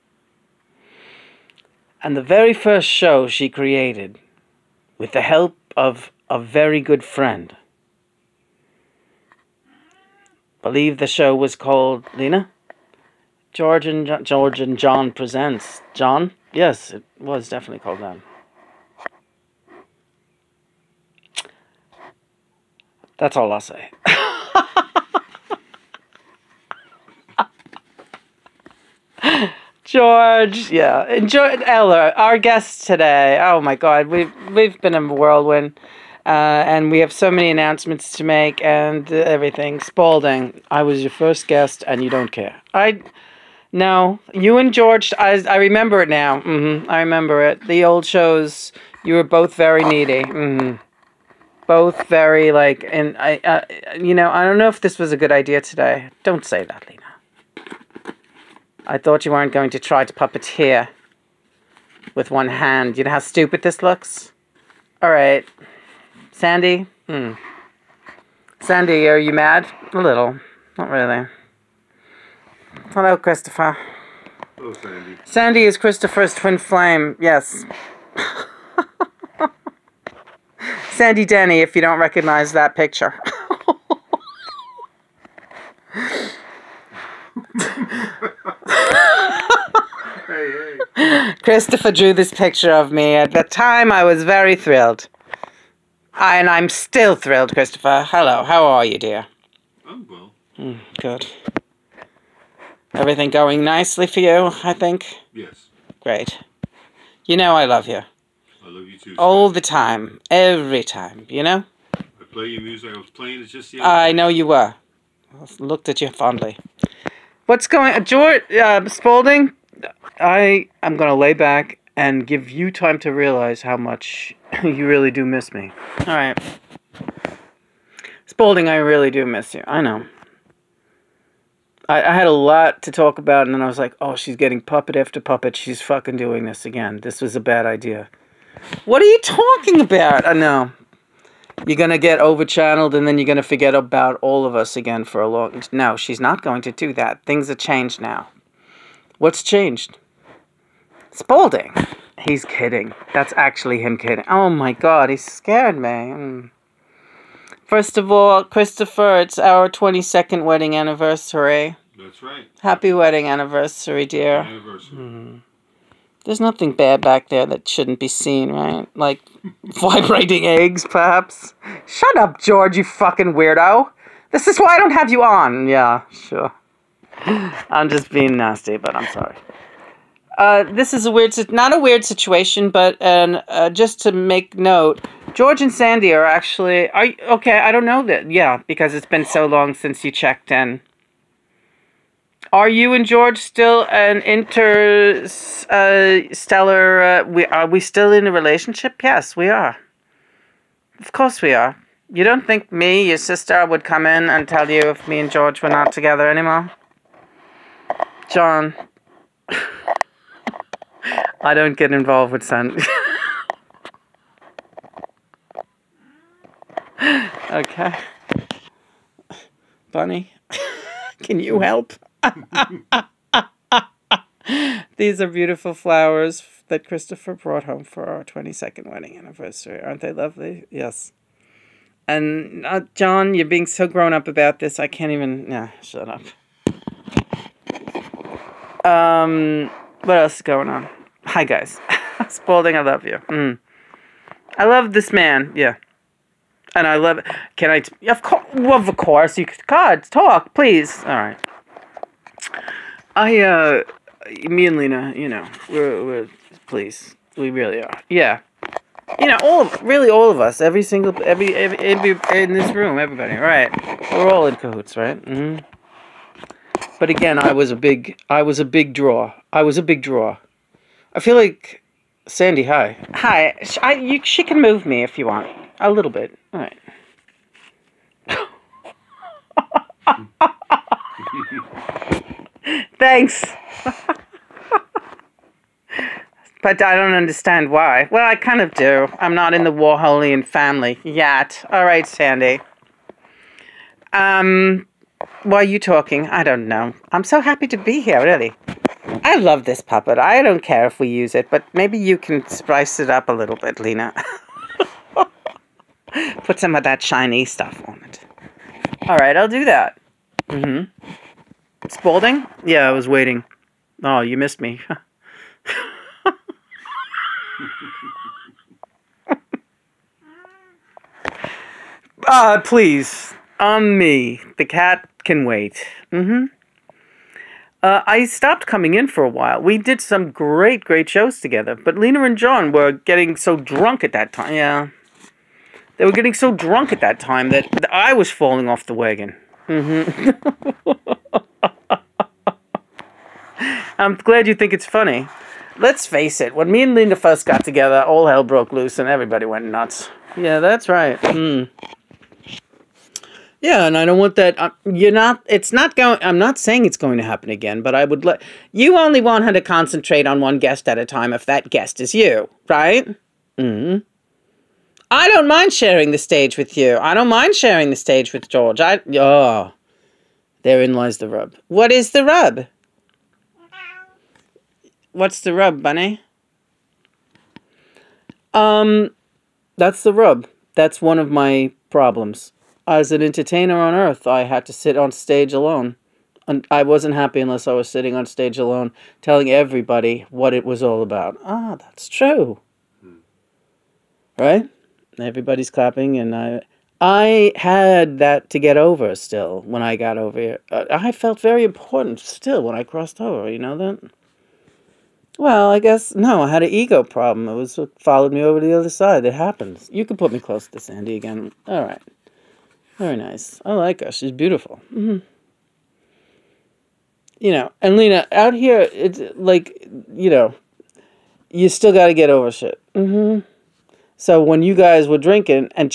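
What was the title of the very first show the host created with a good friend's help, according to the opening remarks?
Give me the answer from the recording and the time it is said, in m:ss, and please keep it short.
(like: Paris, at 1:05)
George and John presents John, at 0:14.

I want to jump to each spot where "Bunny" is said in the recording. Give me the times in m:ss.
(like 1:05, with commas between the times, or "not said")
3:39, 6:15.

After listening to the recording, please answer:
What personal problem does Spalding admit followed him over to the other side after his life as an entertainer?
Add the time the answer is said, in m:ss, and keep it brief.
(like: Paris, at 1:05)
ego problem, at 6:46.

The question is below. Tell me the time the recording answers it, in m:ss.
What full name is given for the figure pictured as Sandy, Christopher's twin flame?
1:20.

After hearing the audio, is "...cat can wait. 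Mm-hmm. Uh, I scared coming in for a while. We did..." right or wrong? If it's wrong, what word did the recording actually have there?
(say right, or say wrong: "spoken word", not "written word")
wrong: "stopped", not "scared".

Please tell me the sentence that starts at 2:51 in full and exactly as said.
Shut up, George, you fucking weirdo.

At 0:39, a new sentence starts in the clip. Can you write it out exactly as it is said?
Spalding, I was your first guest, and you don't care.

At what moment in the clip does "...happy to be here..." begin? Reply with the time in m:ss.
4:57.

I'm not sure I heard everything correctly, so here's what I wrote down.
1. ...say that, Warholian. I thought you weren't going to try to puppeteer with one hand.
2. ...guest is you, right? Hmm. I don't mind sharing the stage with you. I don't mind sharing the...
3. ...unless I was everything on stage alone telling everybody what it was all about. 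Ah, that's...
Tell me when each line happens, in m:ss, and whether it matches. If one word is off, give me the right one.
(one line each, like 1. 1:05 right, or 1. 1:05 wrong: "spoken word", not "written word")
1. 0:56 wrong: "Lena", not "Warholian"
2. 6:01 right
3. 6:27 wrong: "sitting", not "everything".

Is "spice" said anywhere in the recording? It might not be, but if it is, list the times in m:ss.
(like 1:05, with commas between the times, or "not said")
5:02.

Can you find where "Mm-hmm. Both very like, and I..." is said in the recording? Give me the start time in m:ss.
0:50.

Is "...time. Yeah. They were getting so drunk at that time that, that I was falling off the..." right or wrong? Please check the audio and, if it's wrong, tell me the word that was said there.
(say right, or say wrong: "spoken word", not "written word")
right.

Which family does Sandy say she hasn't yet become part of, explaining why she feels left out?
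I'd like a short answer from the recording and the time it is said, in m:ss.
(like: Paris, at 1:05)
Warholian family, at 4:49.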